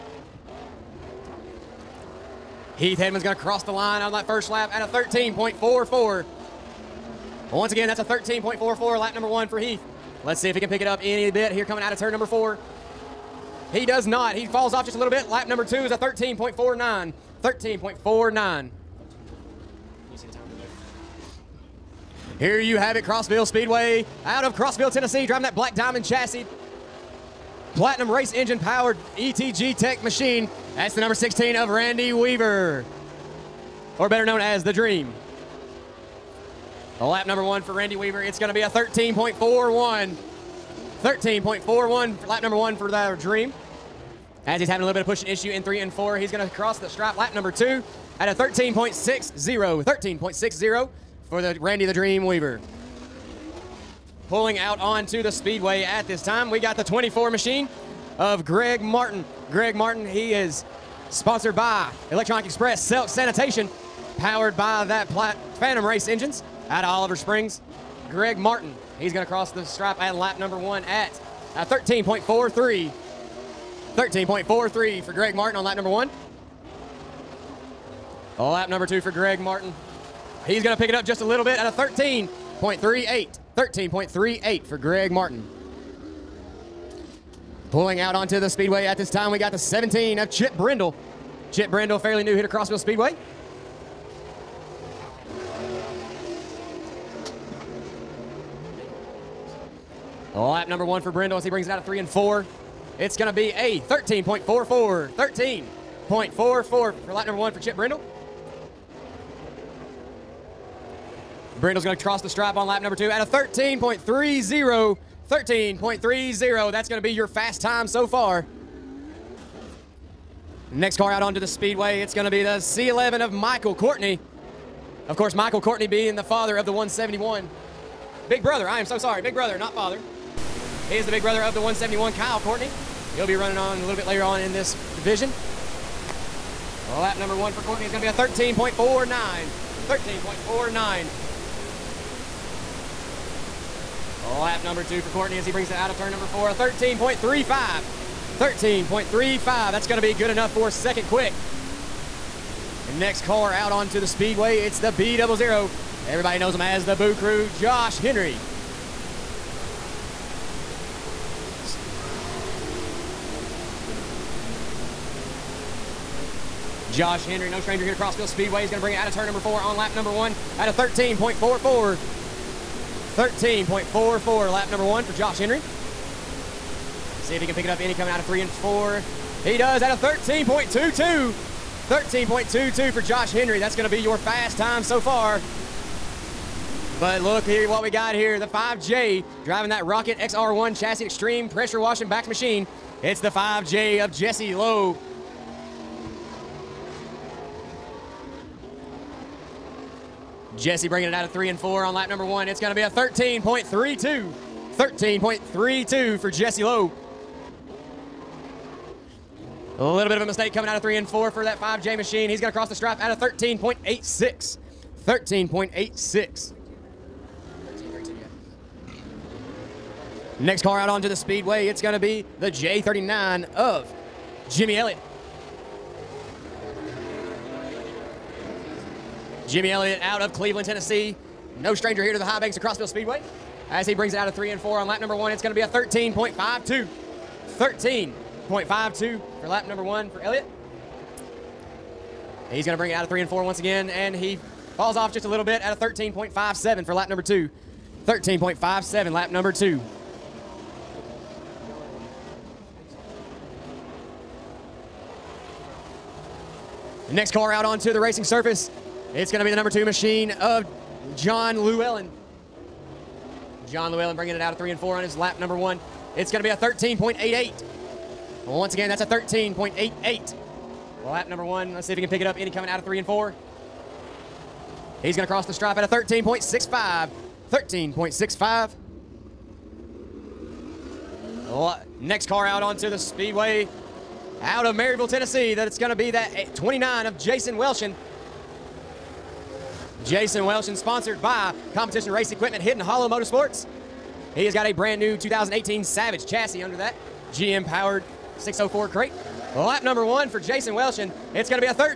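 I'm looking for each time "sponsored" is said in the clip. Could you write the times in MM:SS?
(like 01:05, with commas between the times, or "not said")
01:01, 04:50.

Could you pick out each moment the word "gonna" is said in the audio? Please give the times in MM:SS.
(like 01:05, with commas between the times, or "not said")
00:03, 02:29.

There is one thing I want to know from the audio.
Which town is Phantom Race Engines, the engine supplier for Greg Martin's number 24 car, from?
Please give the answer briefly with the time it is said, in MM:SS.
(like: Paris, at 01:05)
Oliver Springs, at 01:06.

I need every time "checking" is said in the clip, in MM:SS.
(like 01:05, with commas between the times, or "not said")
not said.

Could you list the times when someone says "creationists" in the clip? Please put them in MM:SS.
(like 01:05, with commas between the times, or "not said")
not said.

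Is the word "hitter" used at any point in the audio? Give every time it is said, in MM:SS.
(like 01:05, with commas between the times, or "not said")
01:32.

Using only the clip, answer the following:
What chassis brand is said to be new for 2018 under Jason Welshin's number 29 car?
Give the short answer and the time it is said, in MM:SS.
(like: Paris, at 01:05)
Savage, at 04:55.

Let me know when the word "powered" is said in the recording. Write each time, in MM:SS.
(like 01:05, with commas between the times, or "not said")
00:28, 01:04, 04:57.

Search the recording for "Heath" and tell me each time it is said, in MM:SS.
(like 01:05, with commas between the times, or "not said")
00:02, 00:09.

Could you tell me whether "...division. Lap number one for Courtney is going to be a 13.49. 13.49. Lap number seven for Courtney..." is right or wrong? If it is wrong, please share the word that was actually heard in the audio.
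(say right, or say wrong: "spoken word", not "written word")
wrong: "two", not "seven".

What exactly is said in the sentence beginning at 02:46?
Josh Henry, no stranger here to Crossville Speedway.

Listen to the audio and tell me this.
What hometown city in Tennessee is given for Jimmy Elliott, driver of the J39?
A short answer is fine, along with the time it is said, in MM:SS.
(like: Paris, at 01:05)
Cleveland, at 03:50.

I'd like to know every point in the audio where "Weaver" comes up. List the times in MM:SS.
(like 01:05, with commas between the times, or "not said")
00:32, 00:37, 00:52.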